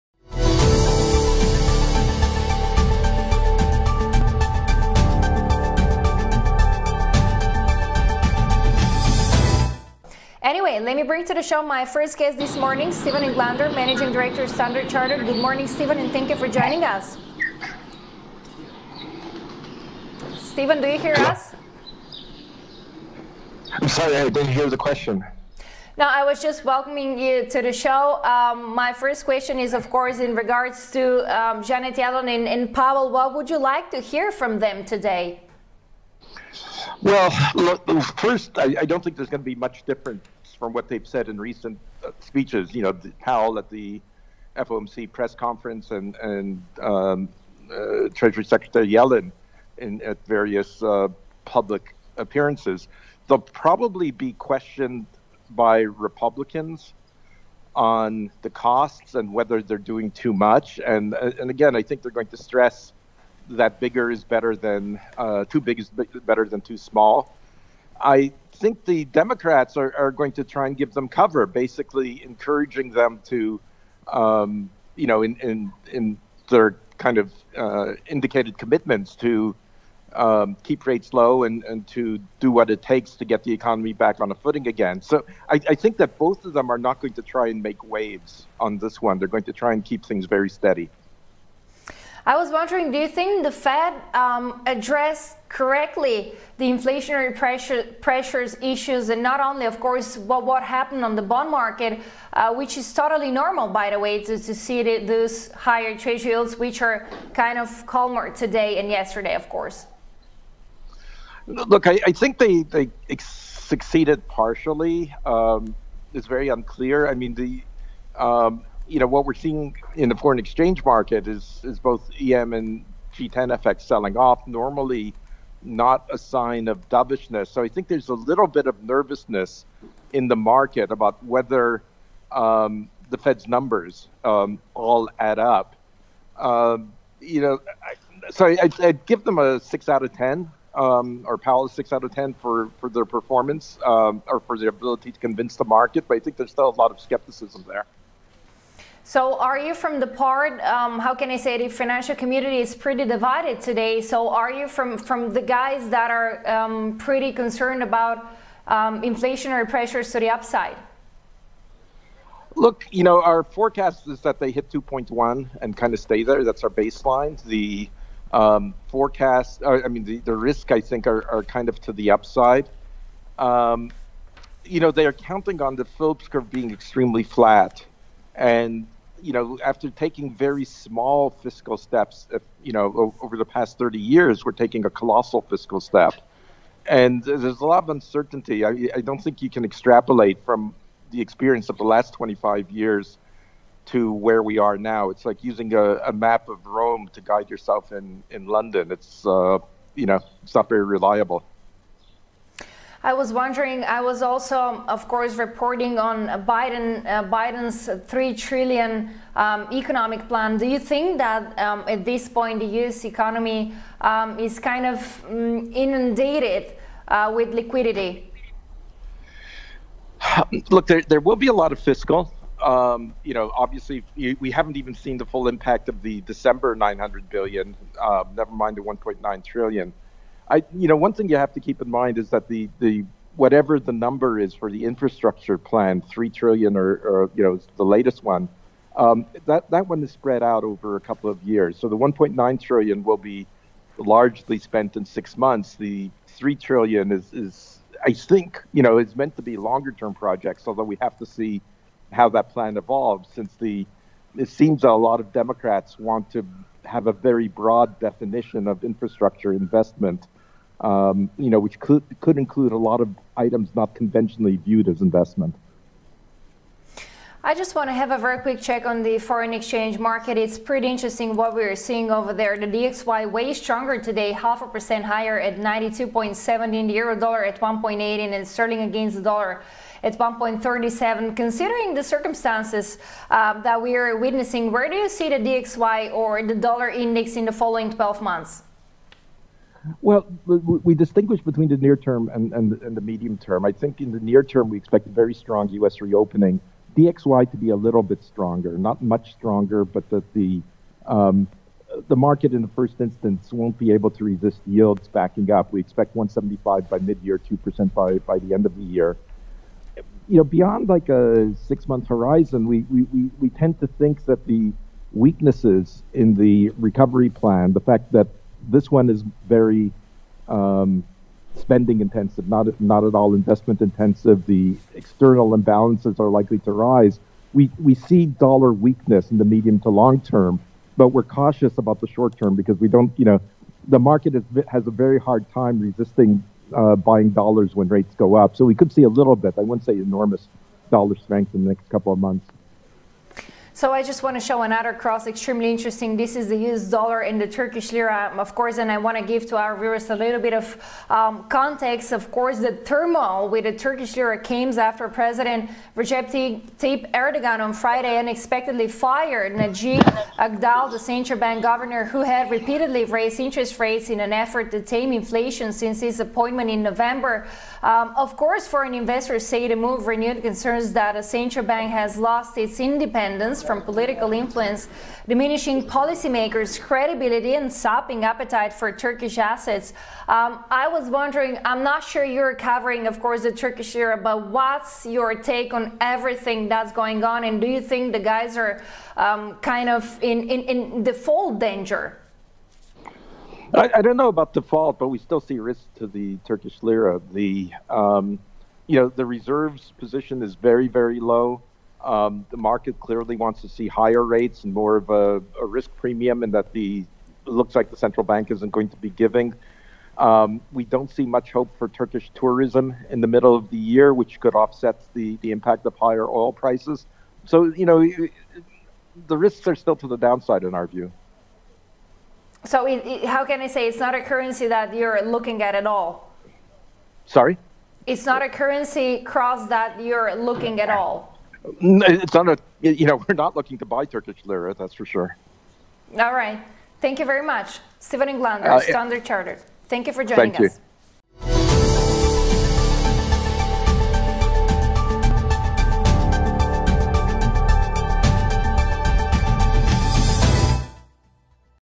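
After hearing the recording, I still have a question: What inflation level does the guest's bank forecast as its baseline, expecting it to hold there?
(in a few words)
2.1.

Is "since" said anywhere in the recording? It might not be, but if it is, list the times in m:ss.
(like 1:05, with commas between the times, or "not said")
4:13, 6:05.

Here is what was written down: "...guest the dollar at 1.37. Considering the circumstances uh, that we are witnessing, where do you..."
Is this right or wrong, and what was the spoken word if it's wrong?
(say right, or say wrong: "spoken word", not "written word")
wrong: "against", not "guest".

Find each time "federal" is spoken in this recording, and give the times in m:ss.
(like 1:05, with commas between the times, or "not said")
not said.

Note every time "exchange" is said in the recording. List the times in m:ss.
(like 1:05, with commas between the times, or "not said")
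2:00, 4:29.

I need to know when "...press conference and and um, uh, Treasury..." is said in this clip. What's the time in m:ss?
0:45.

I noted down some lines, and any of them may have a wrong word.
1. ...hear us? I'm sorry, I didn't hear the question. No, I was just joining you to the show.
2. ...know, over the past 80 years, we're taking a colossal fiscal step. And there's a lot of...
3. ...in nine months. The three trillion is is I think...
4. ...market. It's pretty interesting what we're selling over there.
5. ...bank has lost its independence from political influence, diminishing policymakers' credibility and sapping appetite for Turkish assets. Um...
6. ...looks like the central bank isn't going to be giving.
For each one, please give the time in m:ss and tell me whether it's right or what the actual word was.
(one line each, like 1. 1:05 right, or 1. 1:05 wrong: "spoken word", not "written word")
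1. 0:20 wrong: "welcoming", not "joining"
2. 3:02 wrong: "30", not "80"
3. 4:04 wrong: "six", not "nine"
4. 4:29 wrong: "seeing", not "selling"
5. 6:11 right
6. 6:47 right.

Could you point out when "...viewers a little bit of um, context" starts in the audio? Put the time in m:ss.
5:49.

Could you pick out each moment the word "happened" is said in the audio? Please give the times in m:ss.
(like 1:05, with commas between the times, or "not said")
1:40.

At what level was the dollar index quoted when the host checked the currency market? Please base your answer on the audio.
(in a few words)
92.7.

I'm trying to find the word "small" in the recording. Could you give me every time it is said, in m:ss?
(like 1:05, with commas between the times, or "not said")
1:06, 3:00.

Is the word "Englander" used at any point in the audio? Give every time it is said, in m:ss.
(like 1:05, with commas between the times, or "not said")
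0:13, 7:18.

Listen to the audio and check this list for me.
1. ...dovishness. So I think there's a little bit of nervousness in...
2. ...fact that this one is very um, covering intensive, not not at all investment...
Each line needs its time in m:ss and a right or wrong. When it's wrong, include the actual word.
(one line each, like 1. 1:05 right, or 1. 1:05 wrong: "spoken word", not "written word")
1. 2:06 right
2. 5:17 wrong: "spending", not "covering".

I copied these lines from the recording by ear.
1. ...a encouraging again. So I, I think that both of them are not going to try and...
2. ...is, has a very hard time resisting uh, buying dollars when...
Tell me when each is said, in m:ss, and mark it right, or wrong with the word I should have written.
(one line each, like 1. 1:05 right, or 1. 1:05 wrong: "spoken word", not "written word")
1. 1:24 wrong: "footing", not "encouraging"
2. 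5:34 right.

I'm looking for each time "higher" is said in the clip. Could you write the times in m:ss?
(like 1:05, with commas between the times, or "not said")
1:45, 4:35, 6:43, 6:55.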